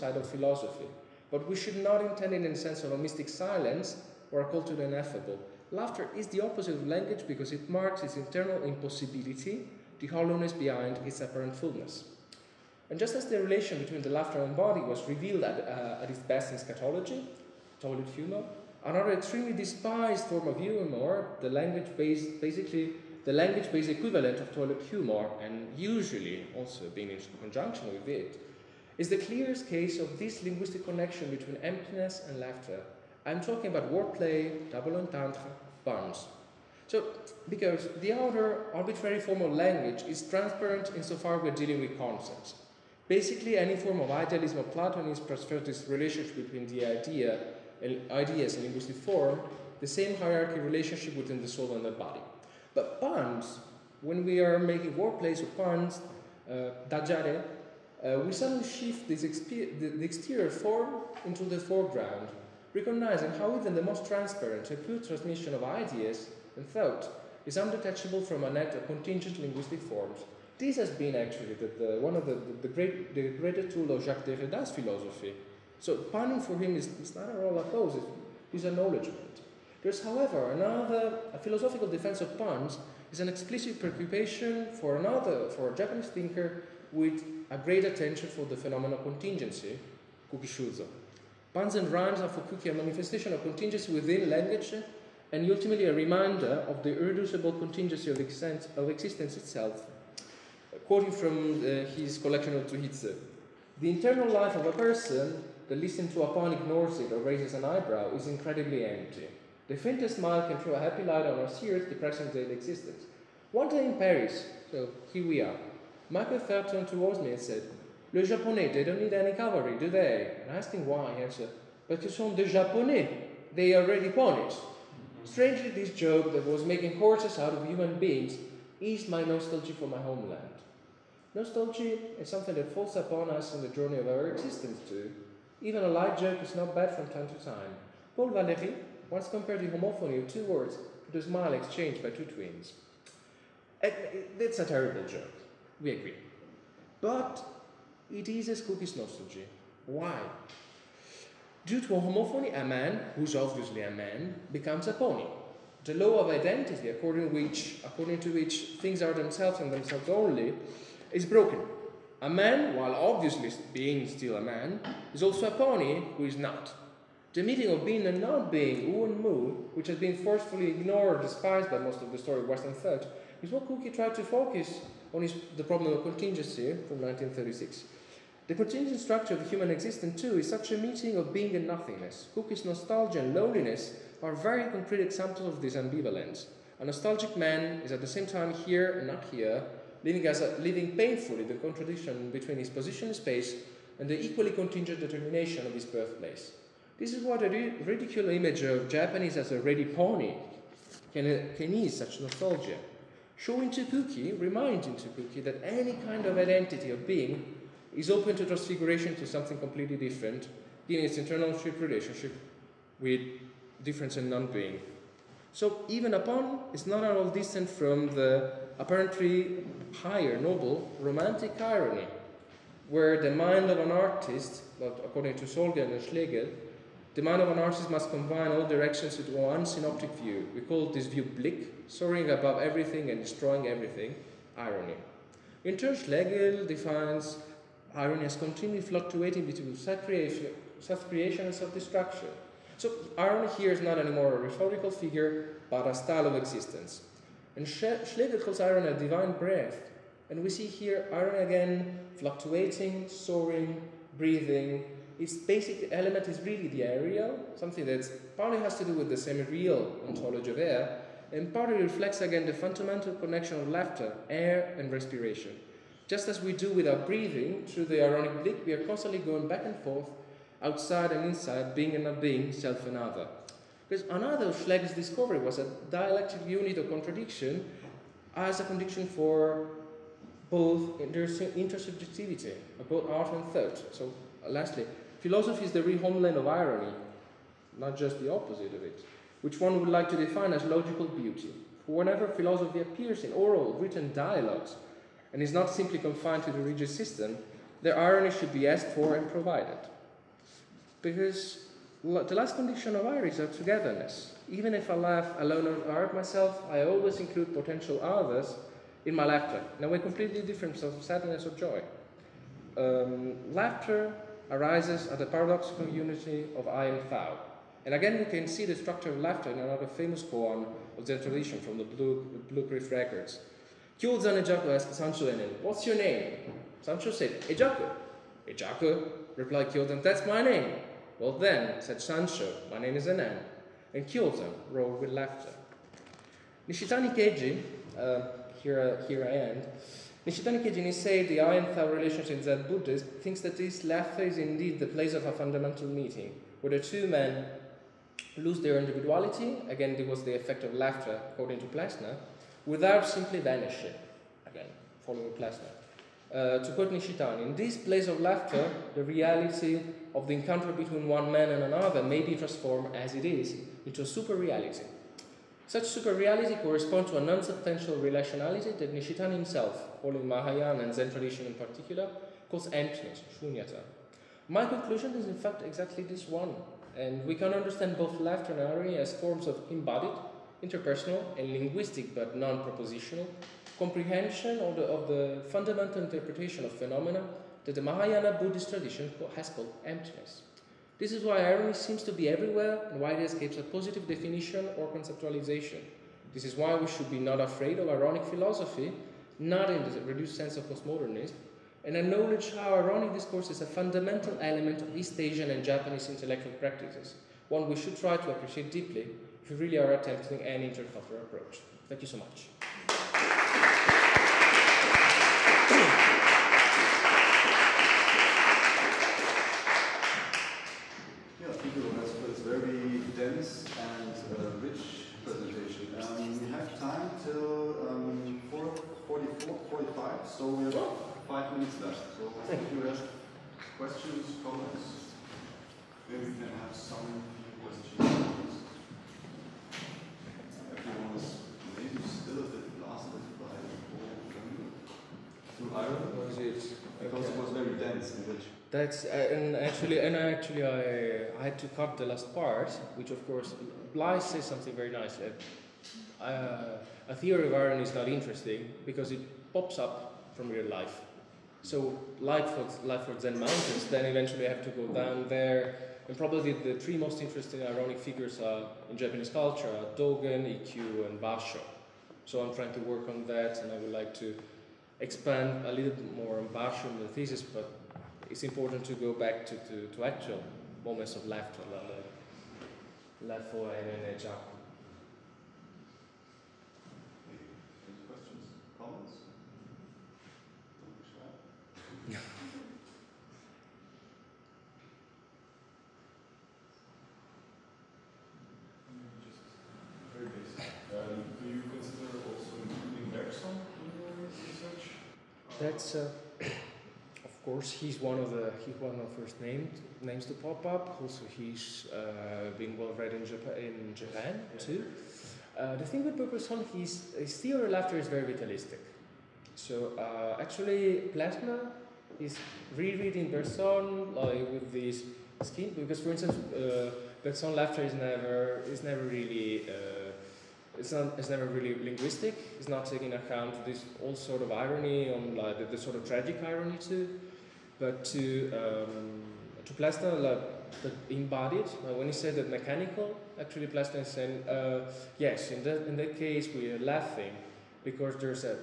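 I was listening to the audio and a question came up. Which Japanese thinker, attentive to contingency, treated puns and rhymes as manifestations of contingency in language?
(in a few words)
Kuki Shuzo.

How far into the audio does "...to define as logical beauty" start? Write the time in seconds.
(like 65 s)
290 s.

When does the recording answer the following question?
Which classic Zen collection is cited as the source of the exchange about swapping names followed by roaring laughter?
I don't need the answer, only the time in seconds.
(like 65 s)
321 s.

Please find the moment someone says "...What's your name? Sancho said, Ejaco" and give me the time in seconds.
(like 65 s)
325 s.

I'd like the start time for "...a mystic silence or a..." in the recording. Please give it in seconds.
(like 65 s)
2 s.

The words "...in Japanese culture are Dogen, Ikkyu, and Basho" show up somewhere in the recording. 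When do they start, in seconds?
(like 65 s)
468 s.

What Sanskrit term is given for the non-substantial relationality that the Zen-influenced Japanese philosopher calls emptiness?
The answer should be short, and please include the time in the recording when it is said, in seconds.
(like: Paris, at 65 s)
Shunyata, at 373 s.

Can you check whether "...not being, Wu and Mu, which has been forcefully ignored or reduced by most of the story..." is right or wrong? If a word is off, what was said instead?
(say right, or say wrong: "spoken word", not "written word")
wrong: "despised", not "reduced".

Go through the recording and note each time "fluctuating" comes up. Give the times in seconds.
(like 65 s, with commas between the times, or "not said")
238 s, 252 s.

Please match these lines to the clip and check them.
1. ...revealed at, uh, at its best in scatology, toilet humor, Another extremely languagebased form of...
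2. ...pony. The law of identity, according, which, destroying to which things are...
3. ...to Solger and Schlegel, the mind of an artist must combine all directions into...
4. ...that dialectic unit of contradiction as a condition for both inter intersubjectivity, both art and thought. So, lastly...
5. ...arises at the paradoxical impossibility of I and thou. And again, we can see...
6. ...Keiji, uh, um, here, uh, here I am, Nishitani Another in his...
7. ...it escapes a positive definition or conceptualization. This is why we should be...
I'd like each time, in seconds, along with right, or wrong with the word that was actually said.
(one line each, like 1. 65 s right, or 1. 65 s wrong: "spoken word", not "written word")
1. 15 s wrong: "despised", not "languagebased"
2. 154 s wrong: "according", not "destroying"
3. 225 s right
4. 275 s right
5. 314 s wrong: "unity", not "impossibility"
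6. 337 s wrong: "Keiji", not "Another"
7. 393 s right.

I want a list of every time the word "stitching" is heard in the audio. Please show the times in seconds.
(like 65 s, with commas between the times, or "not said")
not said.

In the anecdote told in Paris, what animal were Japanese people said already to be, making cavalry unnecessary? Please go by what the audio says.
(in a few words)
Ponies.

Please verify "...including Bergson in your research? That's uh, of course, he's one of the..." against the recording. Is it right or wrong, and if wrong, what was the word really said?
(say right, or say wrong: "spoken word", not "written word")
right.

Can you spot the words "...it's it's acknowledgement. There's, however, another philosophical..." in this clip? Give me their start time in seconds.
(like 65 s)
77 s.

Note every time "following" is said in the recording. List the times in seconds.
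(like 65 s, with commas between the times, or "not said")
355 s, 370 s.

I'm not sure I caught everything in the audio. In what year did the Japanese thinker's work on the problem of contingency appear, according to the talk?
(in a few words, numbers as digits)
1936.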